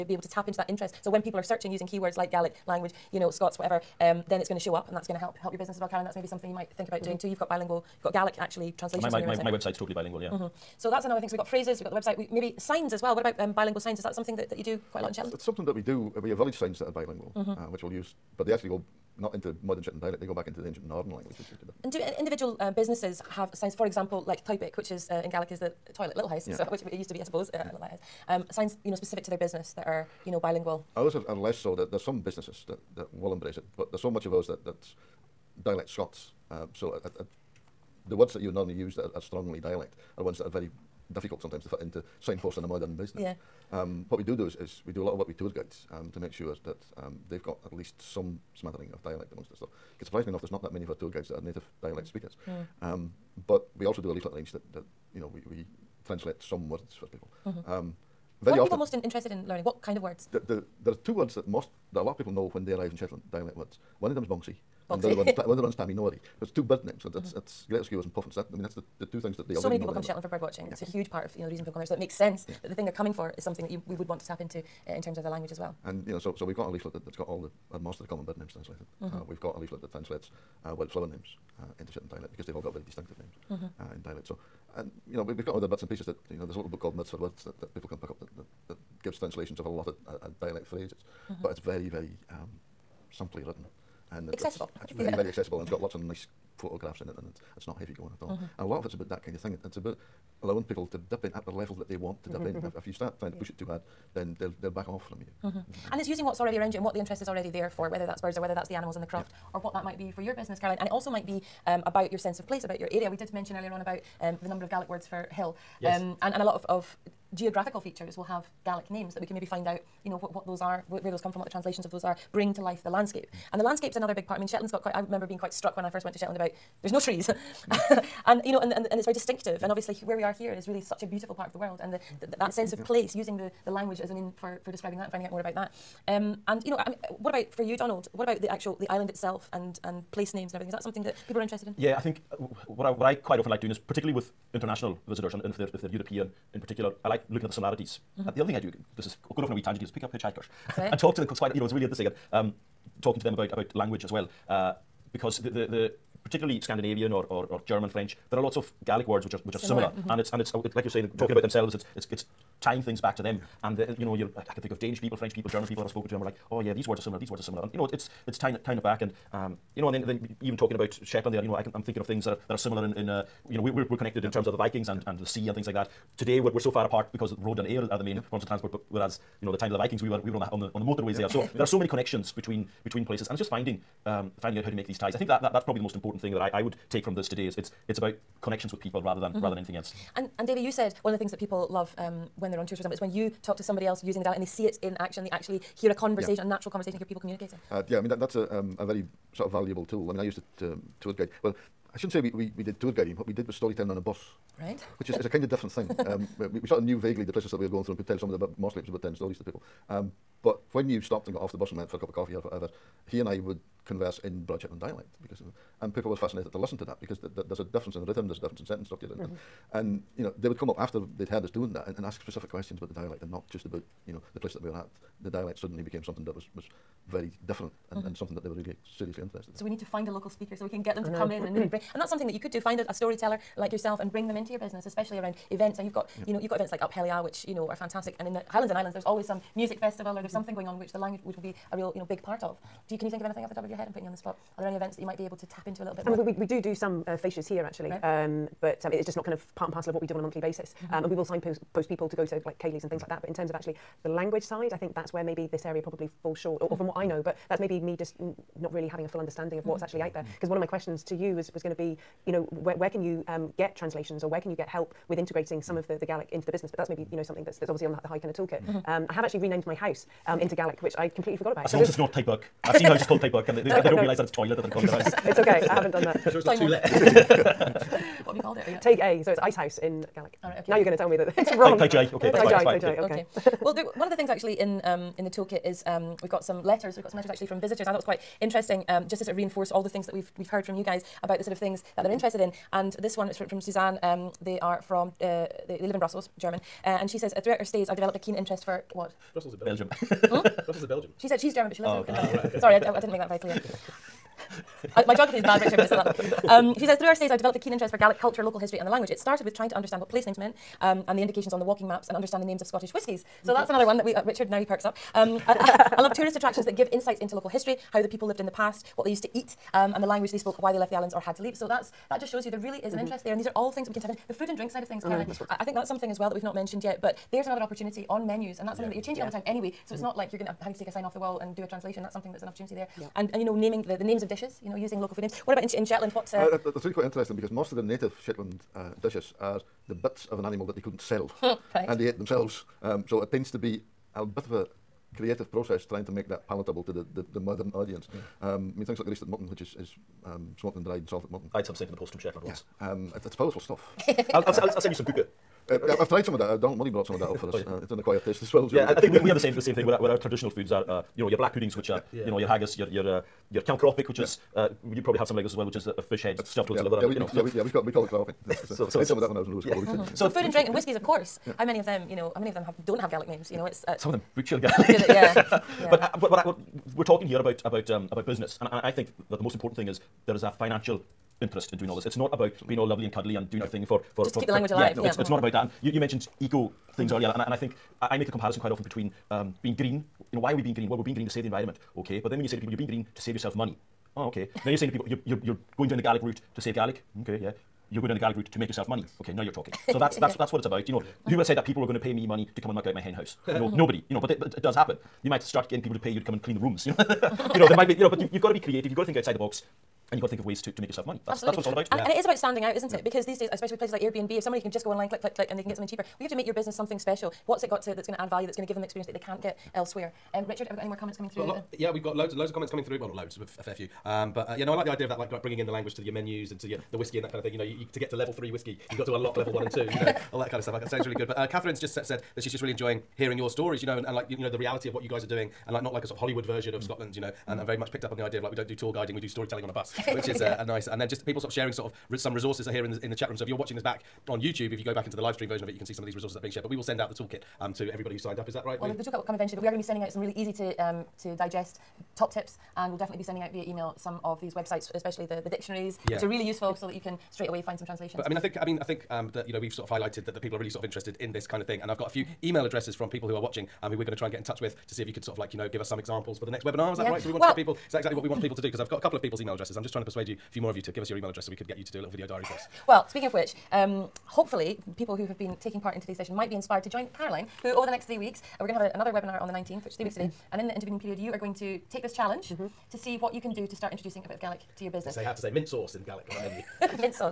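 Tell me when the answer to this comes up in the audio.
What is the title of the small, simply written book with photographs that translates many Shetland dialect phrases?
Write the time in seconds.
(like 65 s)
86 s.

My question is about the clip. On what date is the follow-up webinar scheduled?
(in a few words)
19th.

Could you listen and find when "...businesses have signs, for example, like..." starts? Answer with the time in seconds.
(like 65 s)
22 s.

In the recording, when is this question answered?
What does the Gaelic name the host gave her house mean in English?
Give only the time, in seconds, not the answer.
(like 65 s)
279 s.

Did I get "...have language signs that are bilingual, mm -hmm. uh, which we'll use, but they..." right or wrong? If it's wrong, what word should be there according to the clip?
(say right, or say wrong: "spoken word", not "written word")
wrong: "village", not "language".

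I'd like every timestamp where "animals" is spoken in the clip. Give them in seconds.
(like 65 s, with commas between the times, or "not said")
108 s, 340 s.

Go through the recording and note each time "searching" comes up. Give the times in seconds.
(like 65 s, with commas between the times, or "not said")
1 s.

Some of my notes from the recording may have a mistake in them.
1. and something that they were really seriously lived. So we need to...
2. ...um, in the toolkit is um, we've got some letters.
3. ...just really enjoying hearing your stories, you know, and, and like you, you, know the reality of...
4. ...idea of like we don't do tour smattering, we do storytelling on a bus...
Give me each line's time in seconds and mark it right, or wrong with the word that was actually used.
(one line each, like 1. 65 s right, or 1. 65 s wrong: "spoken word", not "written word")
1. 228 s wrong: "interested", not "lived"
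2. 284 s right
3. 432 s right
4. 438 s wrong: "guiding", not "smattering".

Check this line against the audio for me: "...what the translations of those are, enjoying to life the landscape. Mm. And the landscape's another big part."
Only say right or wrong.
wrong.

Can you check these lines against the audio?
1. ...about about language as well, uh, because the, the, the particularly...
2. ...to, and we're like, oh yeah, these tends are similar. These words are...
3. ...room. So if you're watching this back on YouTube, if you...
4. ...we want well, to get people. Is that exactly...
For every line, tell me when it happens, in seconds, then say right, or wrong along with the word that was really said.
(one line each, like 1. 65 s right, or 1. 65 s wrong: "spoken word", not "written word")
1. 153 s right
2. 166 s wrong: "words", not "tends"
3. 443 s right
4. 467 s right.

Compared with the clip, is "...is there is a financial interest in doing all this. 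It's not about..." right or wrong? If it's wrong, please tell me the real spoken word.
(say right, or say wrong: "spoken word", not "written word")
right.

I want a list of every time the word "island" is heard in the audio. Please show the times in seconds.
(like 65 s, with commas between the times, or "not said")
138 s, 238 s, 320 s.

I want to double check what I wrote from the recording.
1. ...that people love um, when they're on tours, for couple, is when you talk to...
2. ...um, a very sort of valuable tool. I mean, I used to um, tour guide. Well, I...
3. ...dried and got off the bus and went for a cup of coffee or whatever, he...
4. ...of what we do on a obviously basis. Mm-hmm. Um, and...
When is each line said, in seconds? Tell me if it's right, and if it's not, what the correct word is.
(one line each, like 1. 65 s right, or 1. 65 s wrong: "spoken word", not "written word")
1. 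191 s wrong: "example", not "couple"
2. 198 s right
3. 211 s wrong: "stopped", not "dried"
4. 249 s wrong: "monthly", not "obviously".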